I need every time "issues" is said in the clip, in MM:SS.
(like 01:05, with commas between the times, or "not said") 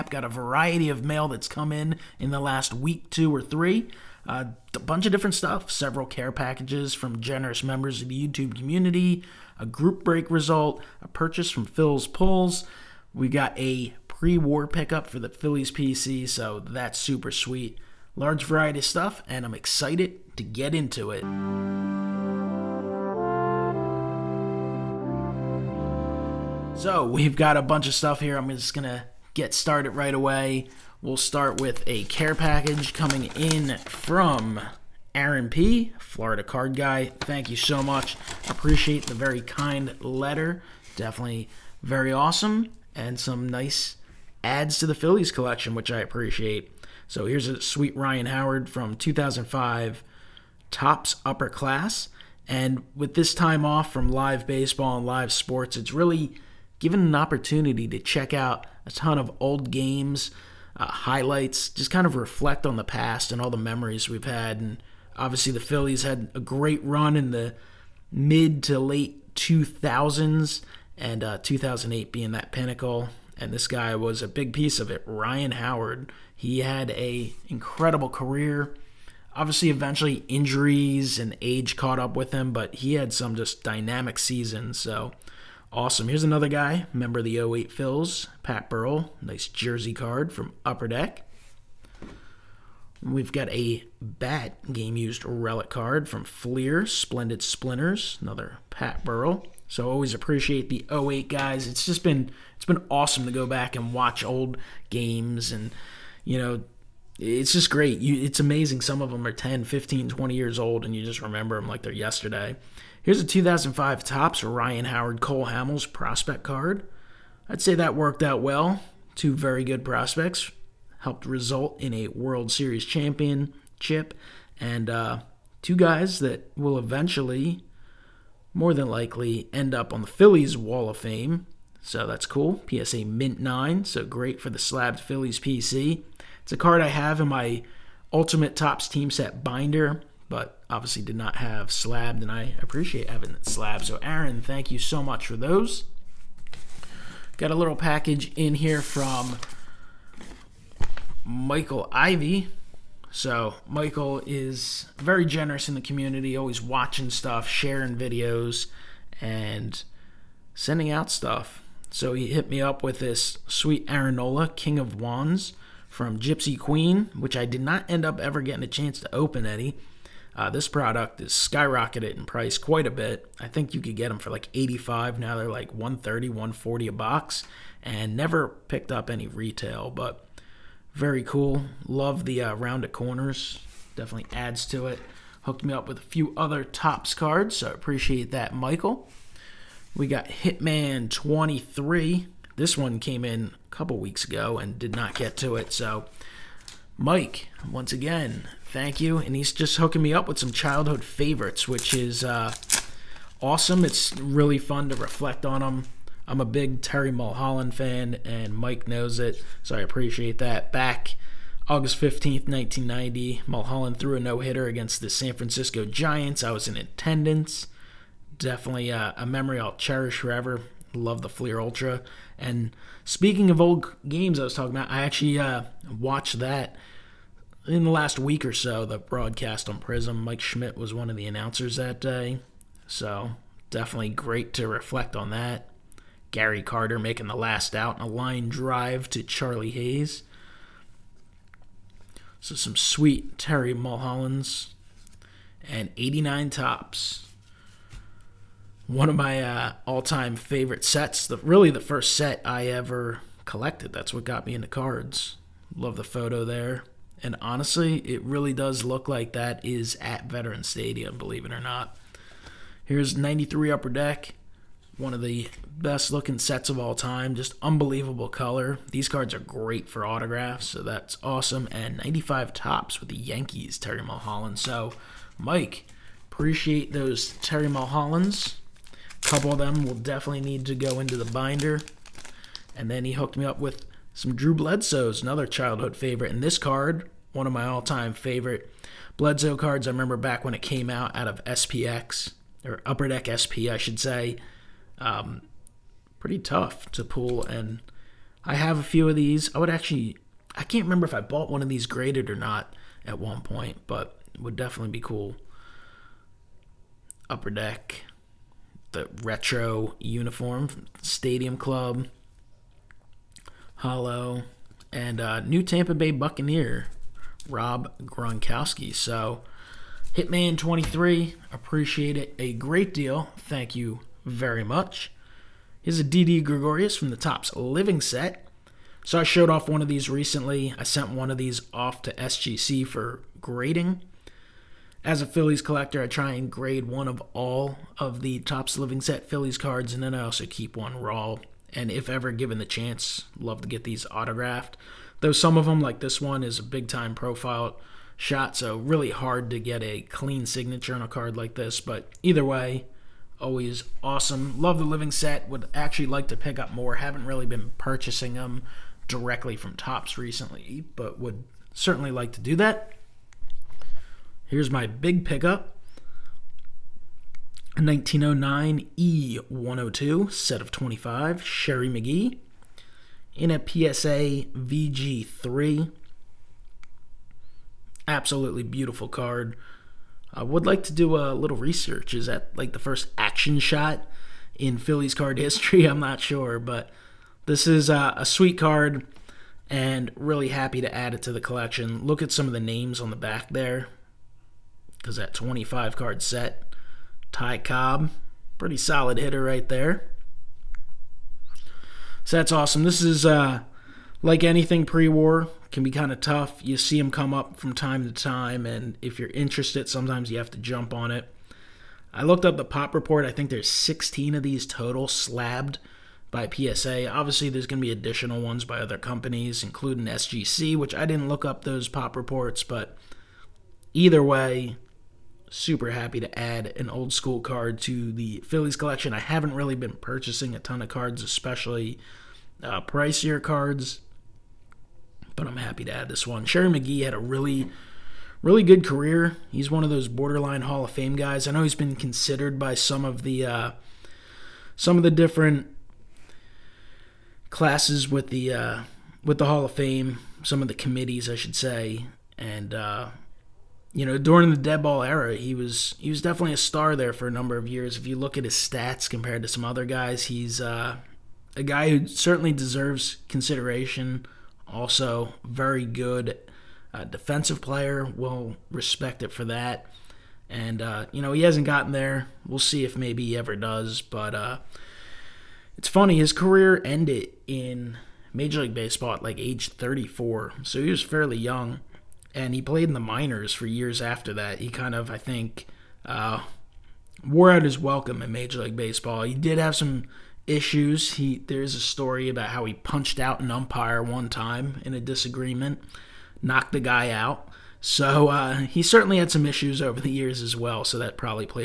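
08:10, 08:19.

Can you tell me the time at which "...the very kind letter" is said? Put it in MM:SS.
00:39.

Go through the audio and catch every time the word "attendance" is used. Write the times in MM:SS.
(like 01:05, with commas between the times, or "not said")
03:36.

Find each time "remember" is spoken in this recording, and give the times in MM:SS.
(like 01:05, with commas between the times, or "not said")
01:51, 04:49, 05:00.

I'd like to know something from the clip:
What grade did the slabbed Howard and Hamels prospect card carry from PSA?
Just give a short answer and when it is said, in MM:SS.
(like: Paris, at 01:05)
Mint 9, at 02:13.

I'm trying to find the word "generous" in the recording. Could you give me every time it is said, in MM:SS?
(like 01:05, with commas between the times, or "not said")
00:07, 02:35.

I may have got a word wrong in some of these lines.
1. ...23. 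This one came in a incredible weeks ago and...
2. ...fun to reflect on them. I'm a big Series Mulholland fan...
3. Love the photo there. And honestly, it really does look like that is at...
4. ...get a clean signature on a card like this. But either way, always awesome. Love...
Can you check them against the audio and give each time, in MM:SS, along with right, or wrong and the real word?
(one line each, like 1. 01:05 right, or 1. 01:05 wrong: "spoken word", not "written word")
1. 03:11 wrong: "couple", not "incredible"
2. 03:24 wrong: "Terry", not "Series"
3. 04:15 right
4. 05:49 right.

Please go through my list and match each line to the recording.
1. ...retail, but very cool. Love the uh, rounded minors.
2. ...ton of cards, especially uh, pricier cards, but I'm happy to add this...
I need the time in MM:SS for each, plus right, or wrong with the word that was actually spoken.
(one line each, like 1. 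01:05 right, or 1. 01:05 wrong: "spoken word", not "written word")
1. 02:59 wrong: "corners", not "minors"
2. 07:10 right.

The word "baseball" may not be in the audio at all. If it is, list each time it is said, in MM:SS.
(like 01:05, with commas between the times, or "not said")
00:54, 07:58, 08:08.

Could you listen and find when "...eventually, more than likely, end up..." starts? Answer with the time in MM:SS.
02:06.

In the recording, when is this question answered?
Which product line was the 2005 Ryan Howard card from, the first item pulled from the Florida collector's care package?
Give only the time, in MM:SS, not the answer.
00:50.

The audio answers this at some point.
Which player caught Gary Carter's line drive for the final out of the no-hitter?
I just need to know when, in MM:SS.
03:59.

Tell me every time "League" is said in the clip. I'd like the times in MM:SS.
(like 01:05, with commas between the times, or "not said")
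07:58, 08:08.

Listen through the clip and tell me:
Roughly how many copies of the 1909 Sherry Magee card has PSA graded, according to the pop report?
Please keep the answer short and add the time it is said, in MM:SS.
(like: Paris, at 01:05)
16, at 06:53.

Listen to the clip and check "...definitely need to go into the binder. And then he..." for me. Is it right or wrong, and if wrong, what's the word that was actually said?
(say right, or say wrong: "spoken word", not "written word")
right.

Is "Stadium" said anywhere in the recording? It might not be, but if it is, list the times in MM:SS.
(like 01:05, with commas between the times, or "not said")
04:20, 05:11.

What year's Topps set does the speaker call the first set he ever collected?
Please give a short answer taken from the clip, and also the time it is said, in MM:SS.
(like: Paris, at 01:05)
1989, at 04:05.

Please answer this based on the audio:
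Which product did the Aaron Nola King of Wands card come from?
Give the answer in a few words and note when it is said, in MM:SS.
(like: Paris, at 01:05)
Gypsy Queen, at 02:46.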